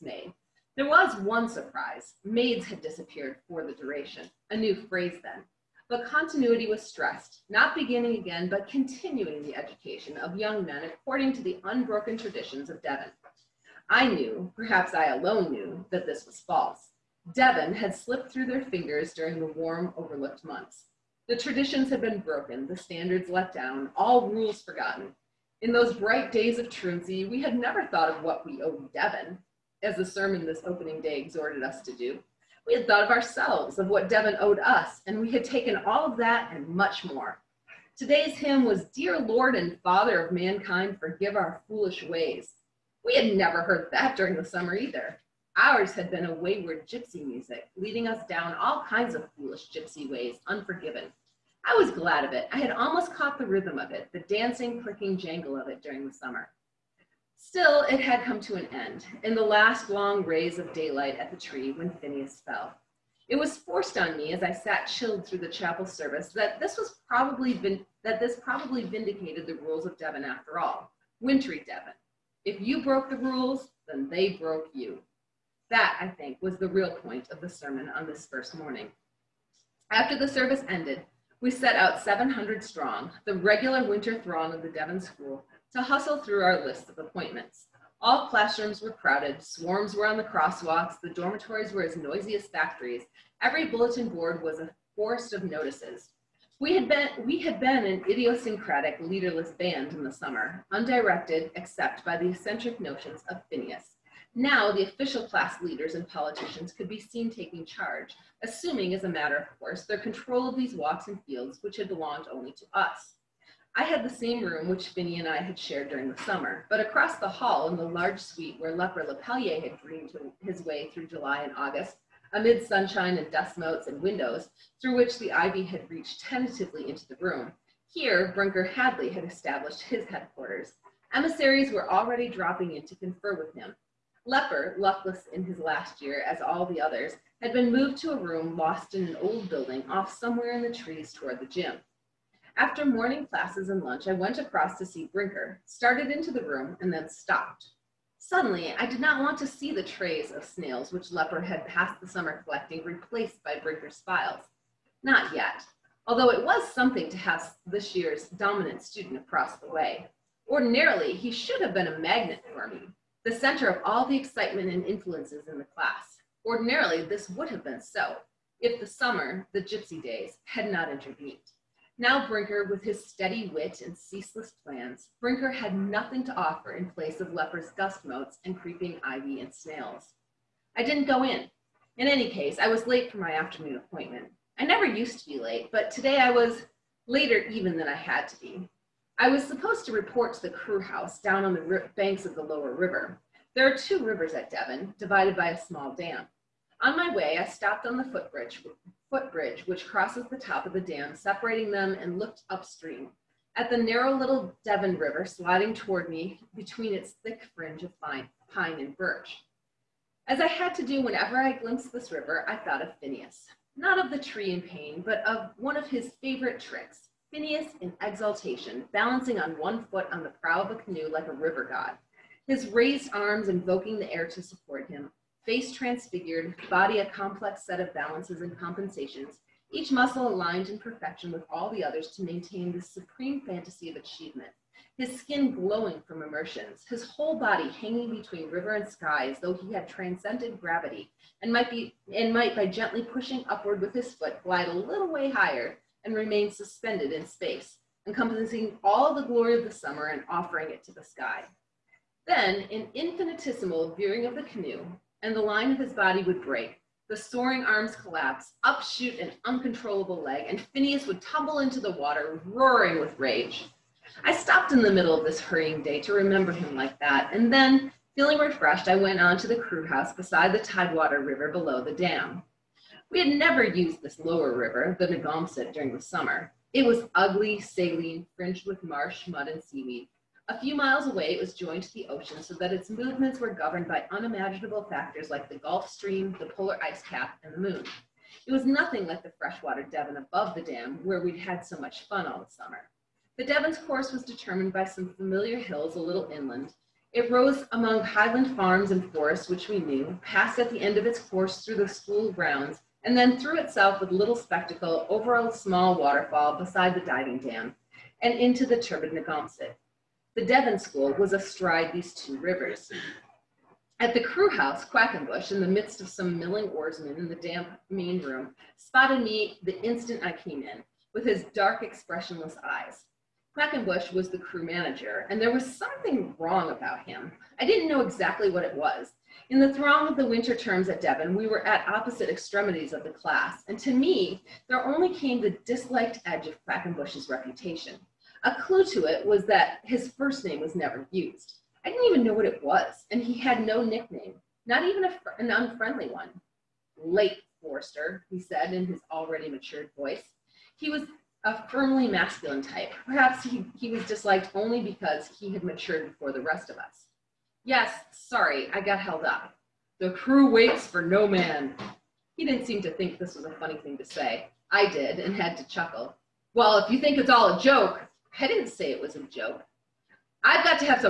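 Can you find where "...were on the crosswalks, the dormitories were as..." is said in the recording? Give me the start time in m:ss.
1:29.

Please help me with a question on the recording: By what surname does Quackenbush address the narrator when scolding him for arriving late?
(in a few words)
Forrester.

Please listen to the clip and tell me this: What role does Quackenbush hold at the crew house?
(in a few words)
Crew manager.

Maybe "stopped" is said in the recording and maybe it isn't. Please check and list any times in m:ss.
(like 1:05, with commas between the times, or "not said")
2:27, 3:17, 4:24.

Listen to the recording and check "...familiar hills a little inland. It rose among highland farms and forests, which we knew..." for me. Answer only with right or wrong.
right.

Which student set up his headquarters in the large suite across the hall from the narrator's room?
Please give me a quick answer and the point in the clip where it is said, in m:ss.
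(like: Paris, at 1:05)
Brinker Hadley, at 2:08.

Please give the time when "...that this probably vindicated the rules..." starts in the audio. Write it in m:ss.
1:08.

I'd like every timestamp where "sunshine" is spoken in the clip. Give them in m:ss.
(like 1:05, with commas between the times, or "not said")
2:02.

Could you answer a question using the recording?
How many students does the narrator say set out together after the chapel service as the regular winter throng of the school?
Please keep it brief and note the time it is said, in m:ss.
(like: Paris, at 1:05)
700, at 1:22.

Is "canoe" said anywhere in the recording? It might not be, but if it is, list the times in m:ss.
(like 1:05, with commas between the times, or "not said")
3:40, 4:14.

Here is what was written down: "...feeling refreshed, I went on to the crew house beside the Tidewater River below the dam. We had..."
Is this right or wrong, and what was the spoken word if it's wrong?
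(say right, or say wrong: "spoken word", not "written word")
right.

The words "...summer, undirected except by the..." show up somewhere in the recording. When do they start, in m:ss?
1:40.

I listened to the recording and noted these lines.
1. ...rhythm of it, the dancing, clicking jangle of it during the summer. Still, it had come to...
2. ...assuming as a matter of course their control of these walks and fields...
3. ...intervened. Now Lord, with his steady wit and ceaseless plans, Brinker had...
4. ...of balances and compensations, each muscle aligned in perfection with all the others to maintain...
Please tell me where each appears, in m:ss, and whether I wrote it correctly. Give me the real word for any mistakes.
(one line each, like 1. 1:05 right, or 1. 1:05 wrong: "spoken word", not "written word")
1. 0:53 right
2. 1:48 right
3. 2:50 wrong: "Brinker", not "Lord"
4. 3:47 right.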